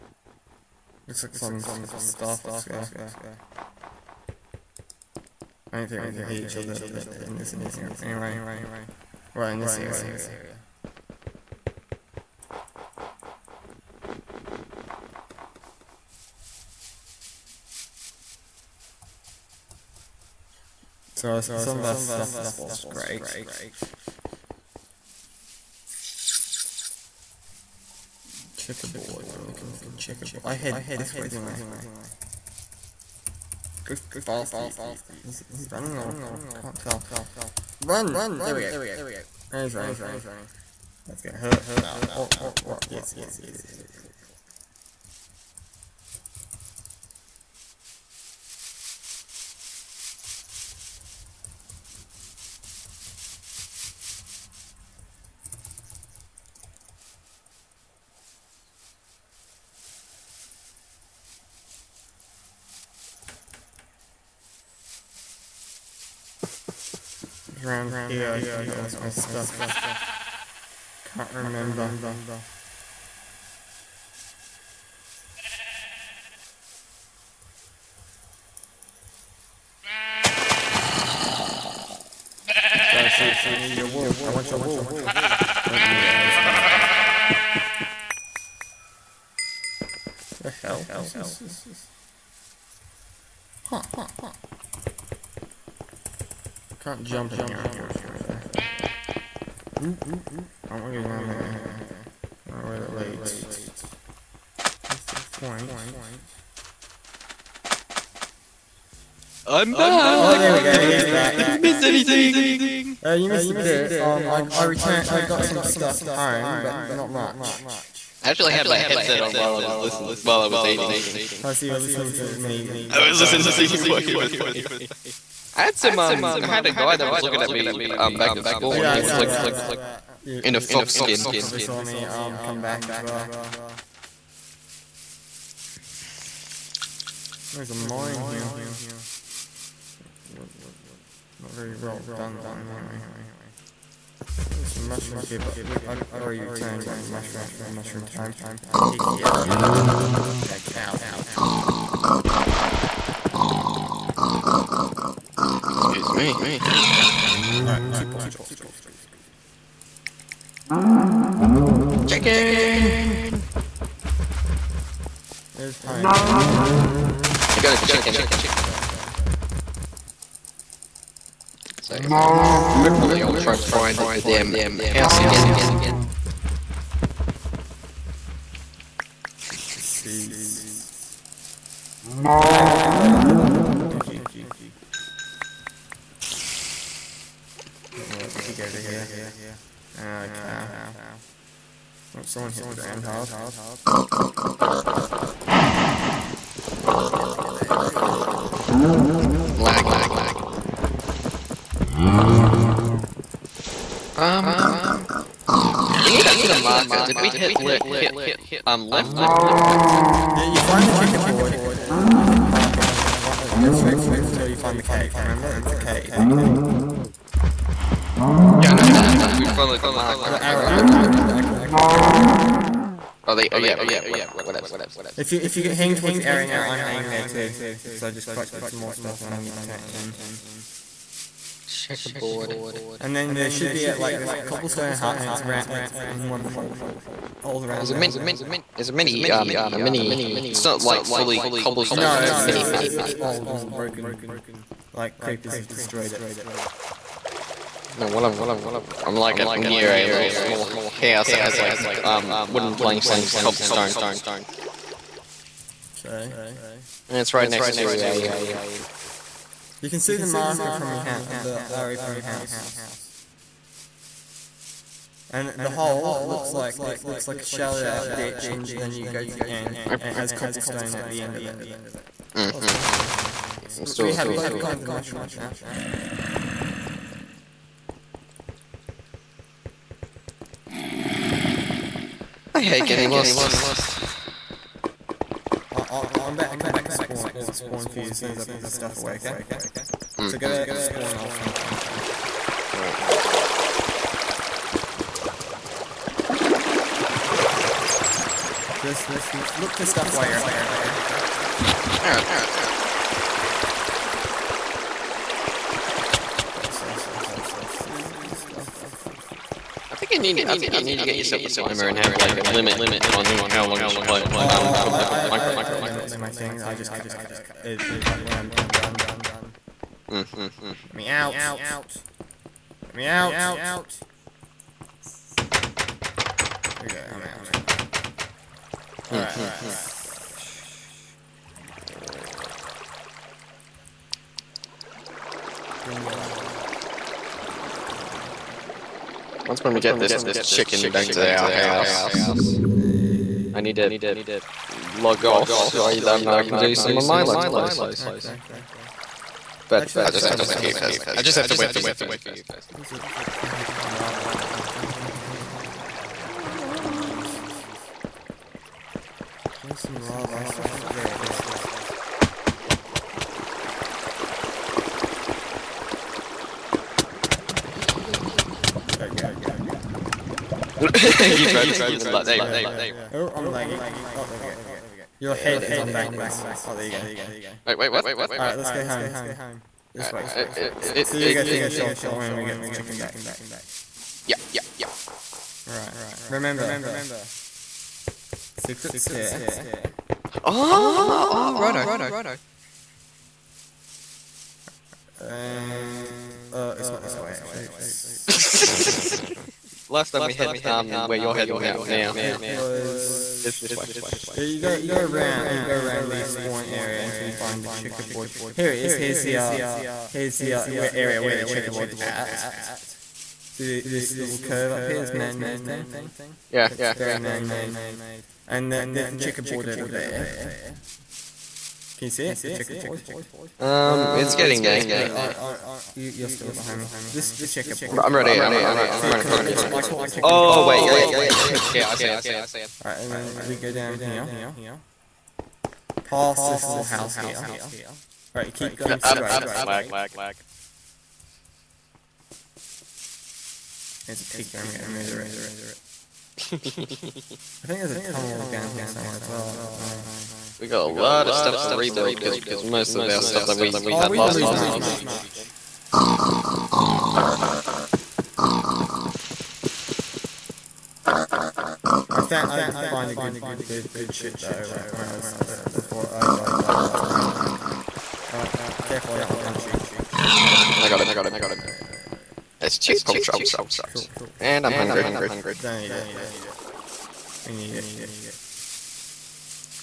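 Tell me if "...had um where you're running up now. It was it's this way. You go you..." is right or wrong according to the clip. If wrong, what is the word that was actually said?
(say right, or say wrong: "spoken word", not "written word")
wrong: "heading", not "running".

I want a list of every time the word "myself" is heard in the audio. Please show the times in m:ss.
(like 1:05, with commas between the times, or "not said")
5:50.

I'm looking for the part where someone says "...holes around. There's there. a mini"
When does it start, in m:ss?
3:57.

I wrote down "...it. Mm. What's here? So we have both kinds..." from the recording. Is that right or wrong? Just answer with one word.
right.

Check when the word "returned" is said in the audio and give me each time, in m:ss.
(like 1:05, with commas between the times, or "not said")
1:54, 2:26.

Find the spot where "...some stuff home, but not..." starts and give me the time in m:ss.
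1:55.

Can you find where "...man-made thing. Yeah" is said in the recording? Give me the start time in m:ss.
6:55.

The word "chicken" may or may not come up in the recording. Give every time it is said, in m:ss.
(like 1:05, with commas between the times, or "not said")
2:42, 2:47, 5:40, 6:22.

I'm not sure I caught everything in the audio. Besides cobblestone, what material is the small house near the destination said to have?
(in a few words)
wooden planks.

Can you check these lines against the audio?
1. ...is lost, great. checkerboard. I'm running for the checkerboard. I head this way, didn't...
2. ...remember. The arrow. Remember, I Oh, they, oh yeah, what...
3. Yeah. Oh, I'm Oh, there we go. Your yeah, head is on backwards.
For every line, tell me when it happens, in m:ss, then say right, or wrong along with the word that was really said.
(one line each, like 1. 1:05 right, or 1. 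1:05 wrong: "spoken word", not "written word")
1. 0:22 wrong: "looking", not "running"
2. 3:39 wrong: "marker", not "remember"
3. 6:12 right.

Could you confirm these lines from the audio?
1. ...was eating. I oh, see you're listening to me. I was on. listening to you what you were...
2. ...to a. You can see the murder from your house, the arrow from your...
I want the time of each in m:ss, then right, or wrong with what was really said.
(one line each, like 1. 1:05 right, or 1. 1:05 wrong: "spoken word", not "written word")
1. 2:00 right
2. 4:17 wrong: "marker", not "murder".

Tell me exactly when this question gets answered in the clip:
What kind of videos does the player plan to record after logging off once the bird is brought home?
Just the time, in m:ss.
5:47.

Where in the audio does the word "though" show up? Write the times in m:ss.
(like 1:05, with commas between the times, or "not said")
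1:38, 7:44.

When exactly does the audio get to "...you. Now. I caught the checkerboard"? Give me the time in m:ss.
7:09.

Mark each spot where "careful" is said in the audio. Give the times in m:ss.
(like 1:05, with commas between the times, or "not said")
7:48.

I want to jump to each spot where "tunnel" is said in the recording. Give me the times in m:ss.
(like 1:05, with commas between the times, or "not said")
7:28.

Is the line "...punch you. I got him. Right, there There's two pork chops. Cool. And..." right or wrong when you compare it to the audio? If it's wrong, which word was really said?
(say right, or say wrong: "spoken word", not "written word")
right.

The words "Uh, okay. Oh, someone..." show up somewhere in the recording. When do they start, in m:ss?
3:09.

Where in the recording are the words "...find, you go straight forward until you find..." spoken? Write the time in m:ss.
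3:33.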